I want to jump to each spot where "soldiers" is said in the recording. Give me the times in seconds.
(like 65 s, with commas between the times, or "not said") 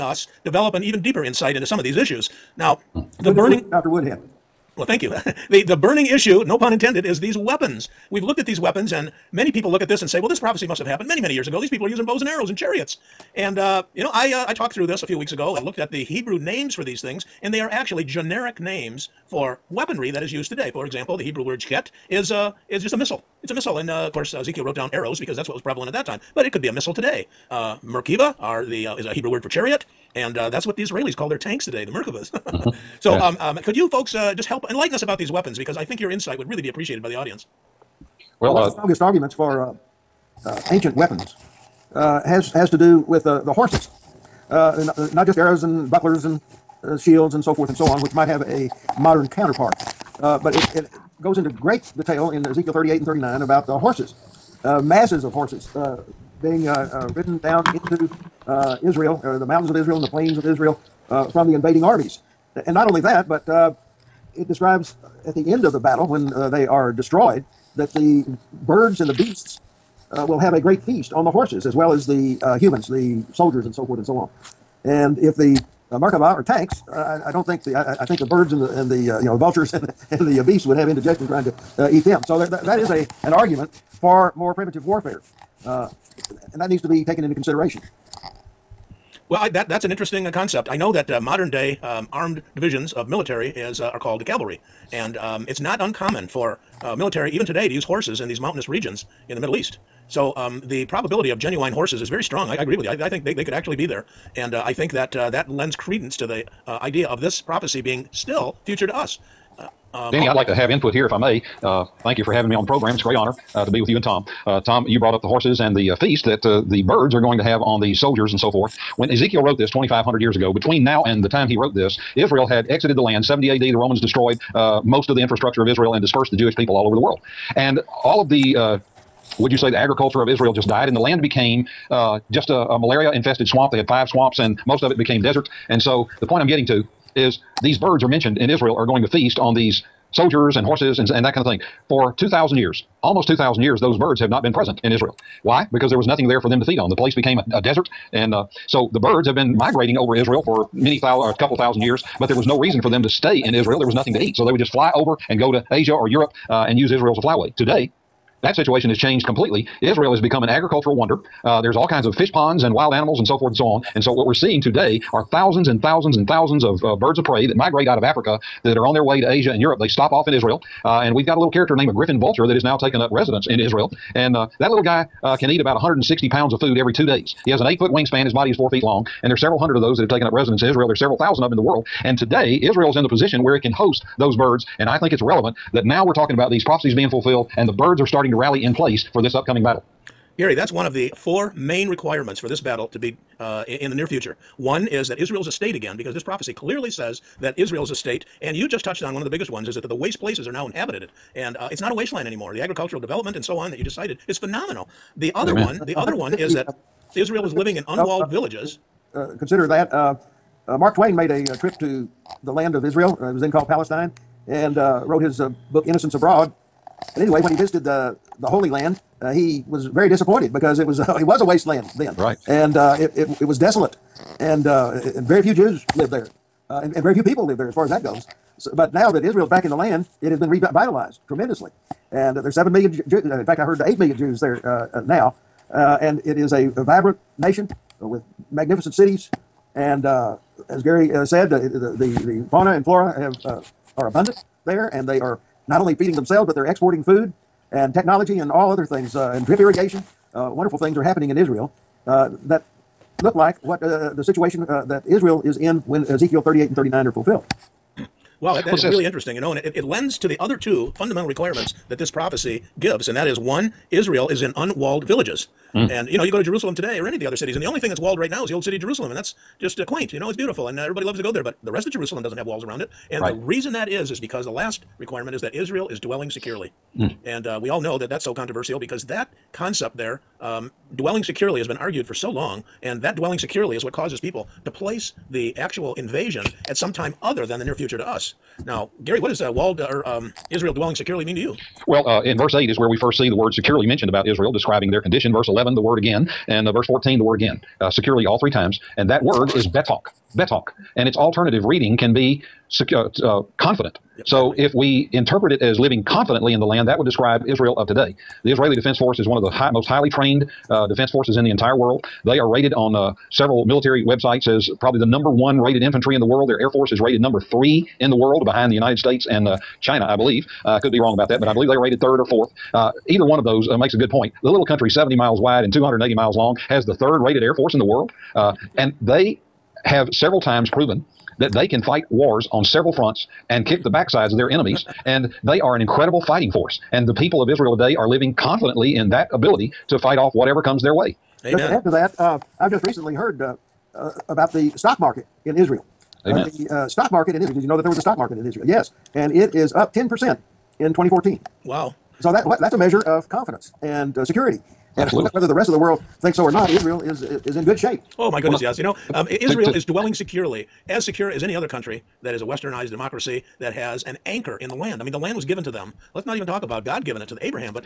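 73 s, 117 s, 140 s.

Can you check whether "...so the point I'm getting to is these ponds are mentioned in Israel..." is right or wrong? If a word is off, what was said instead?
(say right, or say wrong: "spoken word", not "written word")
wrong: "birds", not "ponds".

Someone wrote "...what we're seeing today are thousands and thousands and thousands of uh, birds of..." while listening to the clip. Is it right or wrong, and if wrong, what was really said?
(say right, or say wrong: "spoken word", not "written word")
right.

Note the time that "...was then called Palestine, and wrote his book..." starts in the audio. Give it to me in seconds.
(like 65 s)
213 s.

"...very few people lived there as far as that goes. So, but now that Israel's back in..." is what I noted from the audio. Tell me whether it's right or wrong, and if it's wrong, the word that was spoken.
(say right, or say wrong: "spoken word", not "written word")
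right.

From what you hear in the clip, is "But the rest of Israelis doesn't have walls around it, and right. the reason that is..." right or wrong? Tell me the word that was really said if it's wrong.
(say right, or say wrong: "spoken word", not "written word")
wrong: "Jerusalem", not "Israelis".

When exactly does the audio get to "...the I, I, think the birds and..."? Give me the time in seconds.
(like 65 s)
77 s.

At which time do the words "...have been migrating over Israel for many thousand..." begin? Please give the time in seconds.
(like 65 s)
149 s.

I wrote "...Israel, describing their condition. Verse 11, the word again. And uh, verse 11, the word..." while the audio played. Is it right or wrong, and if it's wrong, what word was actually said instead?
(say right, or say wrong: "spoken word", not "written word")
wrong: "14", not "11".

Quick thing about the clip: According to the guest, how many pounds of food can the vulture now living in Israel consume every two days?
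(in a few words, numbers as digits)
160.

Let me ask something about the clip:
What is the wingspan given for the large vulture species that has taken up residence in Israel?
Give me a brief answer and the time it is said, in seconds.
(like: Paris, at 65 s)
8 feet, at 177 s.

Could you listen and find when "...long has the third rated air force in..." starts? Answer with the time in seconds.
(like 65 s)
326 s.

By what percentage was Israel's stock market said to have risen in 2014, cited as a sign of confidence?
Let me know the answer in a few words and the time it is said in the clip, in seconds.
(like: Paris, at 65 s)
10%, at 349 s.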